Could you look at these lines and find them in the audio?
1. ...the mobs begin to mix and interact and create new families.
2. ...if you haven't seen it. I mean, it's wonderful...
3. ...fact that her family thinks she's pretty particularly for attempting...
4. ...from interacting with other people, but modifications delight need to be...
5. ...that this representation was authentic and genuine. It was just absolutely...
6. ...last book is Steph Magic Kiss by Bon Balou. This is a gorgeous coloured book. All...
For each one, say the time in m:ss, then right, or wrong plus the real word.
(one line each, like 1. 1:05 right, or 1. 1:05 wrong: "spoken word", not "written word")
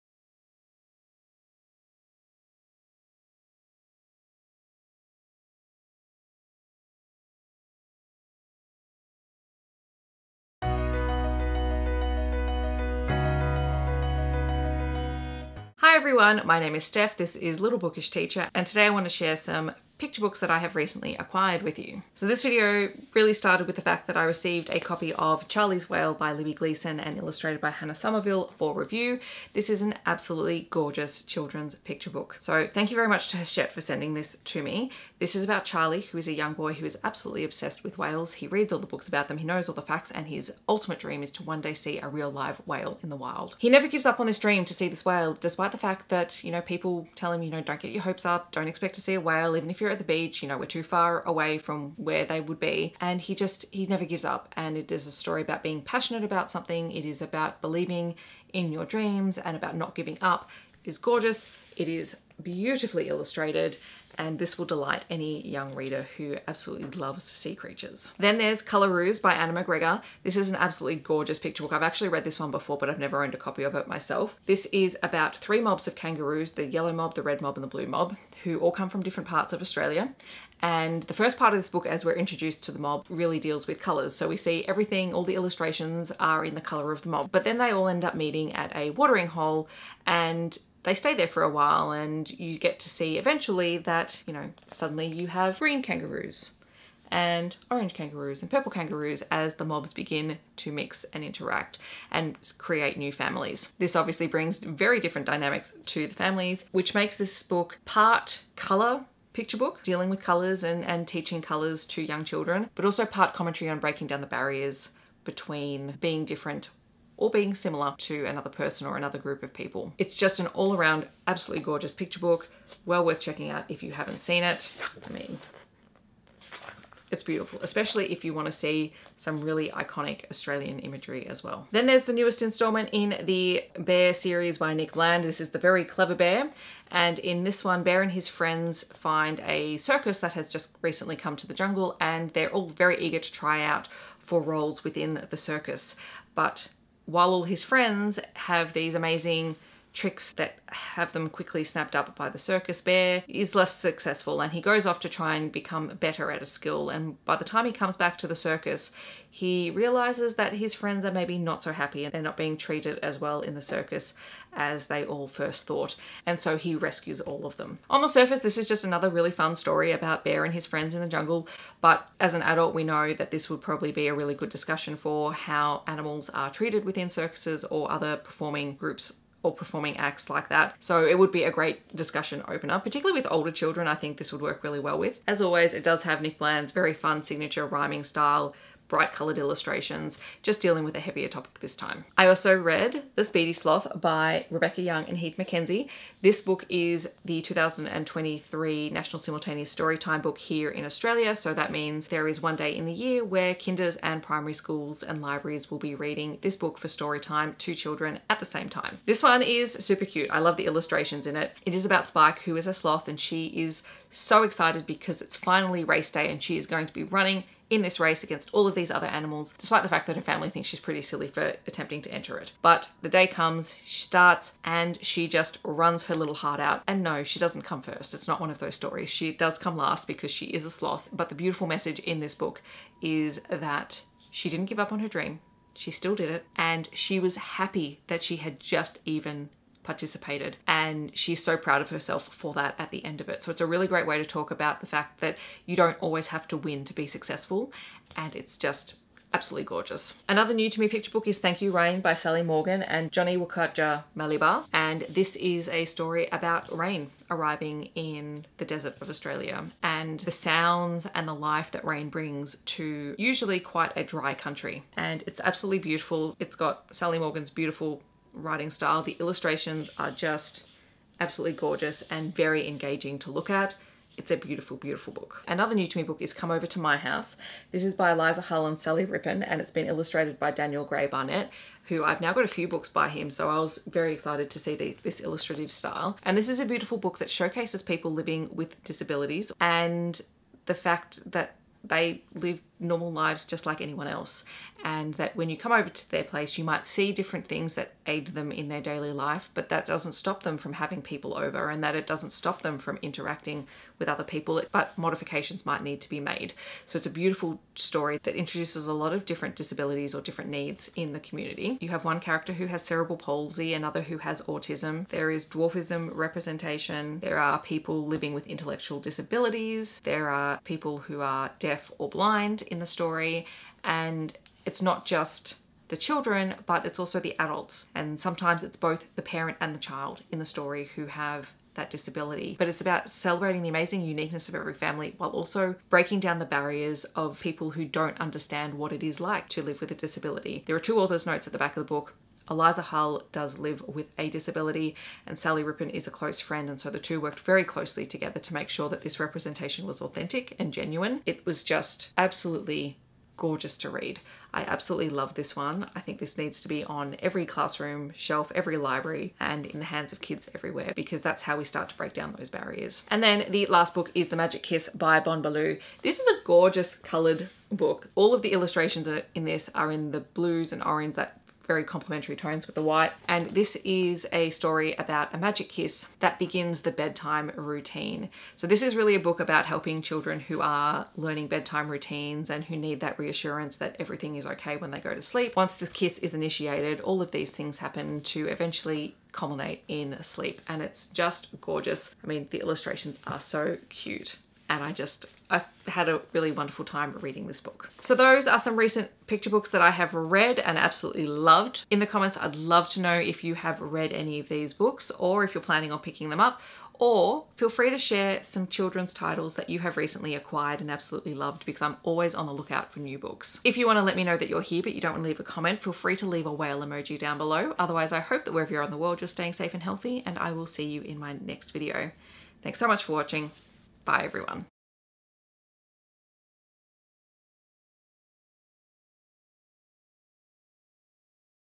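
1. 1:39 right
2. 2:03 wrong: "beautiful", not "wonderful"
3. 3:39 wrong: "silly", not "particularly"
4. 5:02 wrong: "might", not "delight"
5. 5:48 right
6. 6:03 wrong: "The", not "Steph".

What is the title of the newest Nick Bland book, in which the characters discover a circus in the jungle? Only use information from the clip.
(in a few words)
The Very Clever Bear.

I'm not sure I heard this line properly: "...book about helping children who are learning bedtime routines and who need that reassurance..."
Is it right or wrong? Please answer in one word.
right.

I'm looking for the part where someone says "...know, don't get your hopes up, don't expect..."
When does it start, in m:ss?
0:47.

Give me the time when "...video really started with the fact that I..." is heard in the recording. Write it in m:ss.
0:22.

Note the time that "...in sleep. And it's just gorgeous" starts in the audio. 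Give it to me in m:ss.
6:29.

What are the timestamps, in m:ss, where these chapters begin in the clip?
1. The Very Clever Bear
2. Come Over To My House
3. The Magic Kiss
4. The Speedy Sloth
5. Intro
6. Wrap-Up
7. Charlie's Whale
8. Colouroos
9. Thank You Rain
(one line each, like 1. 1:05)
1. 2:11
2. 4:35
3. 6:03
4. 3:12
5. 0:10
6. 6:37
7. 0:22
8. 1:08
9. 4:10.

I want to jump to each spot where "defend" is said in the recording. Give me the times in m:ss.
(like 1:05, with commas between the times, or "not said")
not said.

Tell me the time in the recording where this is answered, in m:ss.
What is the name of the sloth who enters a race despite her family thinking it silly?
3:32.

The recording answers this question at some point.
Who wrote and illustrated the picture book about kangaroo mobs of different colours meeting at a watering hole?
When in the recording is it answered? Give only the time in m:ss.
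1:09.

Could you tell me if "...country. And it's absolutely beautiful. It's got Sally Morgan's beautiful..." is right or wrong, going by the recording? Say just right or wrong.
right.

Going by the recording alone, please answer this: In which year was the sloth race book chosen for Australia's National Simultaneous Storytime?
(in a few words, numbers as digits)
2023.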